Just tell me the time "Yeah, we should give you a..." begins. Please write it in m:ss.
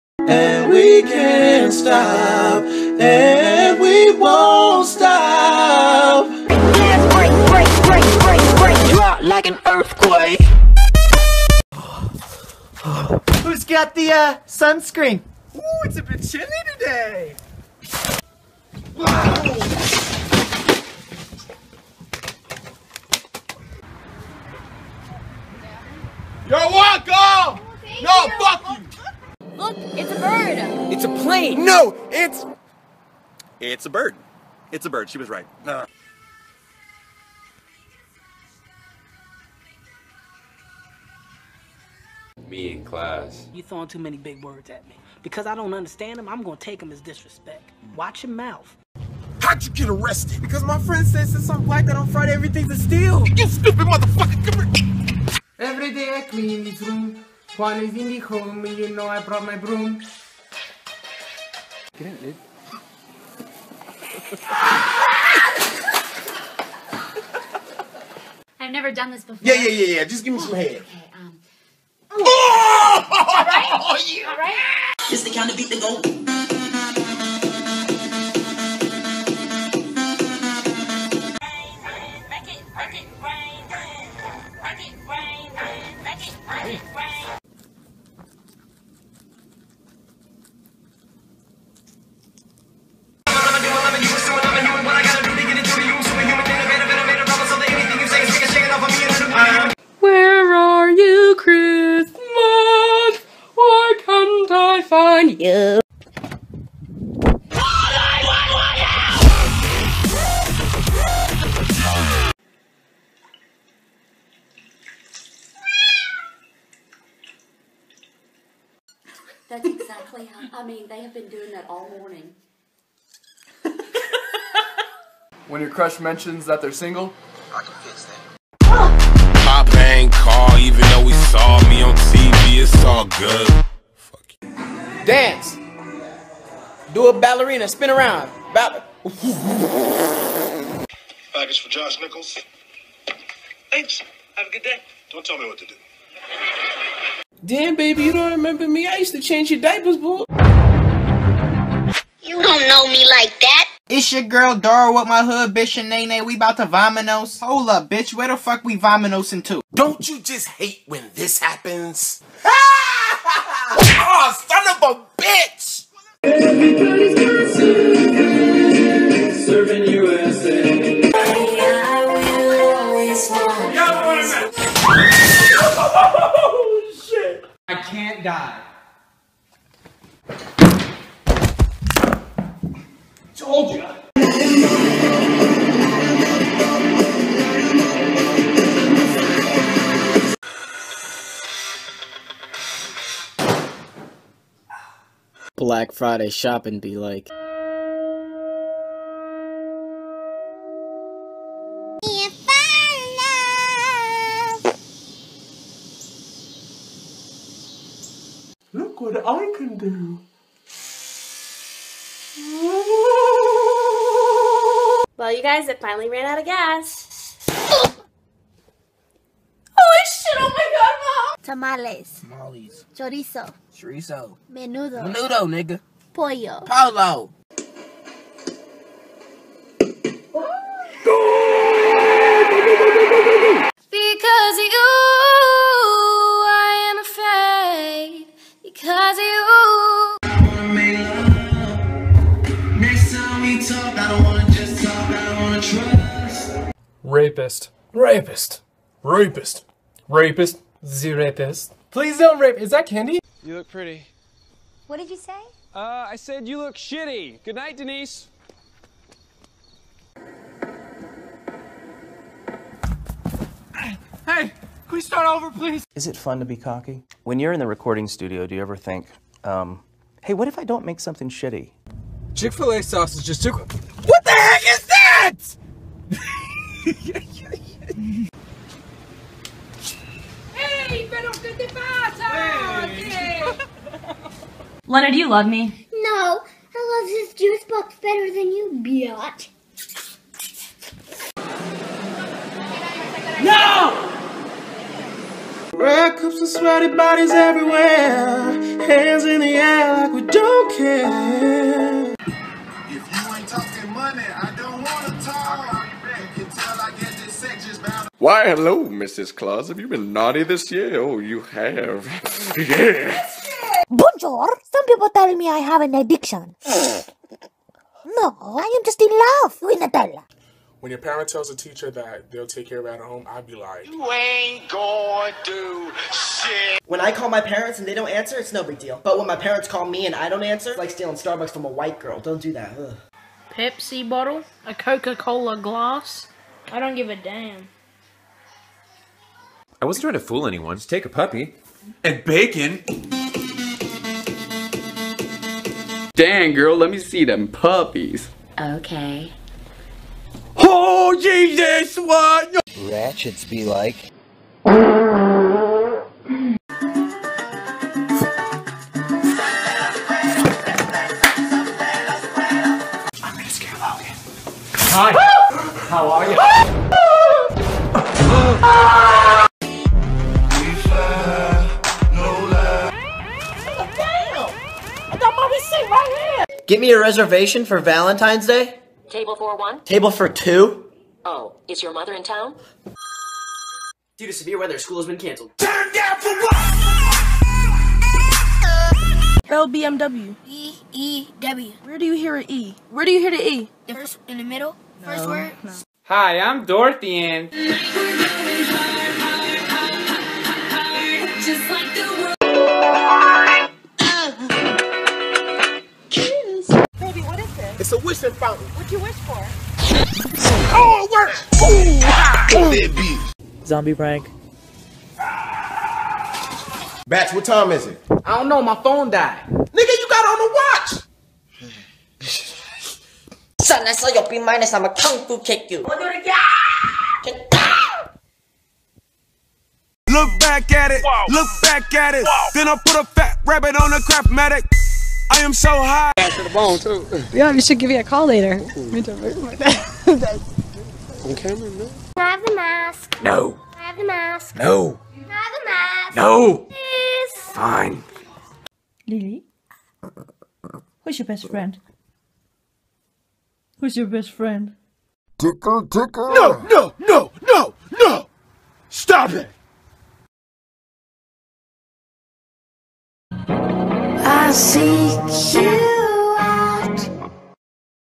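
7:17.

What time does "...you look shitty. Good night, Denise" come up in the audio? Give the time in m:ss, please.
4:16.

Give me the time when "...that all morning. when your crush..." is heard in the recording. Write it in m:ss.
2:01.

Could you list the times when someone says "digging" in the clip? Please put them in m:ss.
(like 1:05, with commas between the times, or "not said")
not said.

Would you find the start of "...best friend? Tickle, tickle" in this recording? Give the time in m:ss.
7:34.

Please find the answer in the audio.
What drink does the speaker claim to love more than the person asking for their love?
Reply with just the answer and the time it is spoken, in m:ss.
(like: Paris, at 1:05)
juice box, at 4:47.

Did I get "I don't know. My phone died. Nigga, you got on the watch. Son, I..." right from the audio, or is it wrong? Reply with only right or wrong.
right.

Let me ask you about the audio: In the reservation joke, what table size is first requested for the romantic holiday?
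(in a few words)
Table for one.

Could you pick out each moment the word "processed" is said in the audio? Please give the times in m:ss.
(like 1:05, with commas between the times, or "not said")
not said.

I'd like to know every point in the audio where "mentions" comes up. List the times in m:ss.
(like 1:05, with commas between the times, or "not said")
2:05.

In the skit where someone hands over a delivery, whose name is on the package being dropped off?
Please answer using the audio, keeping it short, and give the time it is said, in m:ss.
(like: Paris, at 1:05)
Josh Nichols, at 2:21.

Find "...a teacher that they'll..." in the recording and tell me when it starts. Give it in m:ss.
5:21.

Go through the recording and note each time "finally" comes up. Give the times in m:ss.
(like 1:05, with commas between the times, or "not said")
3:35.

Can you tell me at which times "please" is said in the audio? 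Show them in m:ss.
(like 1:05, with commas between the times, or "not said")
4:11, 4:25, 7:26.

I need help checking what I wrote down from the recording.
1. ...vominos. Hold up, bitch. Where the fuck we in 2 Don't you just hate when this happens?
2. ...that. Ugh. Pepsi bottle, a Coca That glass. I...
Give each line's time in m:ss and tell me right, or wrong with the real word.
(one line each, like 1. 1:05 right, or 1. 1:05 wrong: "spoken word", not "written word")
1. 2:36 right
2. 5:32 wrong: "Cola", not "That".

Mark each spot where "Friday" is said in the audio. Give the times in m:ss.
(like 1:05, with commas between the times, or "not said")
0:52, 3:15.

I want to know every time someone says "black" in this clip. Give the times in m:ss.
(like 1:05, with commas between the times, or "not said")
0:51, 3:15.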